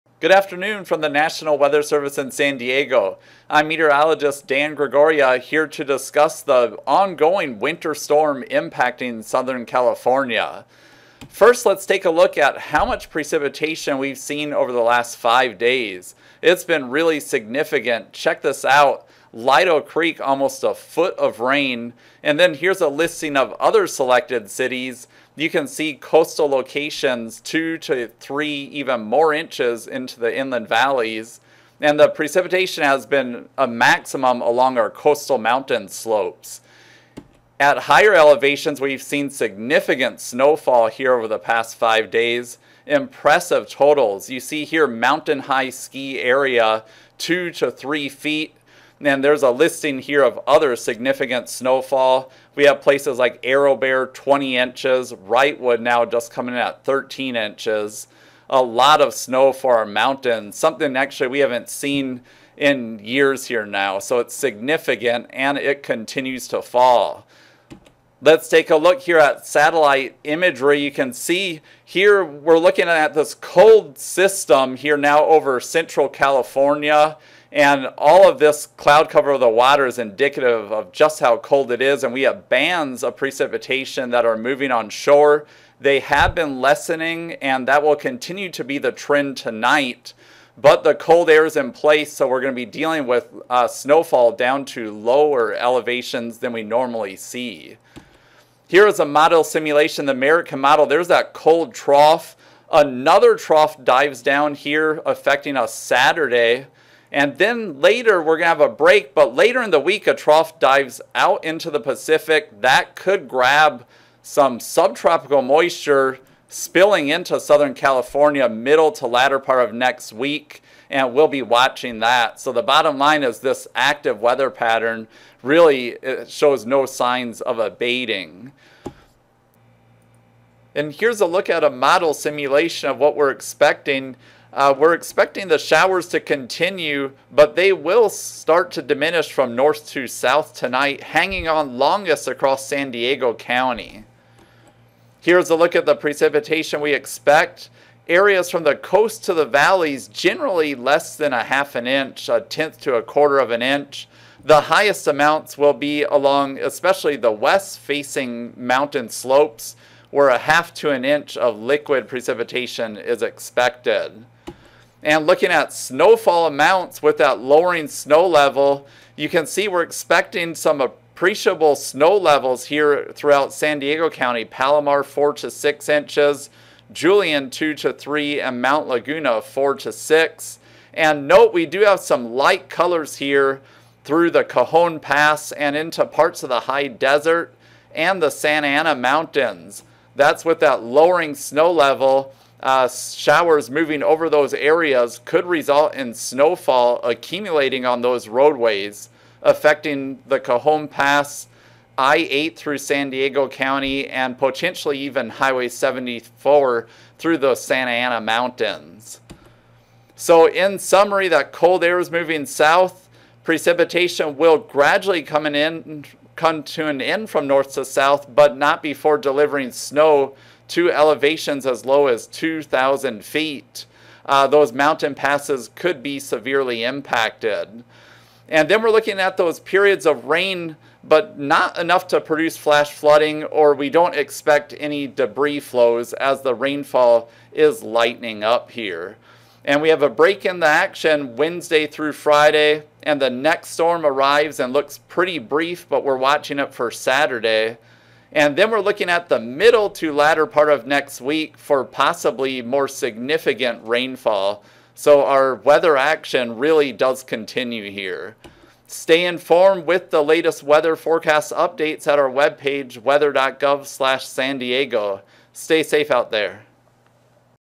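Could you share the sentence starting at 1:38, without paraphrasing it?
Here is a model simulation, the American model.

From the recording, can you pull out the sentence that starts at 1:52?
That could grab some subtropical moisture spilling into Southern California middle to latter part of next week, and we'll be watching that.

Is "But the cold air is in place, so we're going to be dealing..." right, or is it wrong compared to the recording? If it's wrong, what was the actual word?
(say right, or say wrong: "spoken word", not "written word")
right.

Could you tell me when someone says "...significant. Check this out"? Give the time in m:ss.
0:17.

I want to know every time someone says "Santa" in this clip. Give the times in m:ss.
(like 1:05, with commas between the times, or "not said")
3:08, 3:27.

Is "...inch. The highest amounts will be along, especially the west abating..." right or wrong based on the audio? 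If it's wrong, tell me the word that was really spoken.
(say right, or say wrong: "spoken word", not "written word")
wrong: "facing", not "abating".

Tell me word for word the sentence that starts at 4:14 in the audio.
So our weather action really does continue here.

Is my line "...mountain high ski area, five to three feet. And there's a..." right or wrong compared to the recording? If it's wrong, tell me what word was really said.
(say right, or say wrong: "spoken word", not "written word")
wrong: "two", not "five".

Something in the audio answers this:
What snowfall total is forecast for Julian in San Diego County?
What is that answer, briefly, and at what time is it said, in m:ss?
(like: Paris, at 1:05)
2 to 3 inches, at 2:56.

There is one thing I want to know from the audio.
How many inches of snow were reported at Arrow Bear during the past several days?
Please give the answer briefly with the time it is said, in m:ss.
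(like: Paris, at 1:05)
20 inches, at 0:54.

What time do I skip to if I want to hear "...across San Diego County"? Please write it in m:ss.
2:22.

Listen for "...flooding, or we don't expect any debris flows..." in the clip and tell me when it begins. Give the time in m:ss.
3:52.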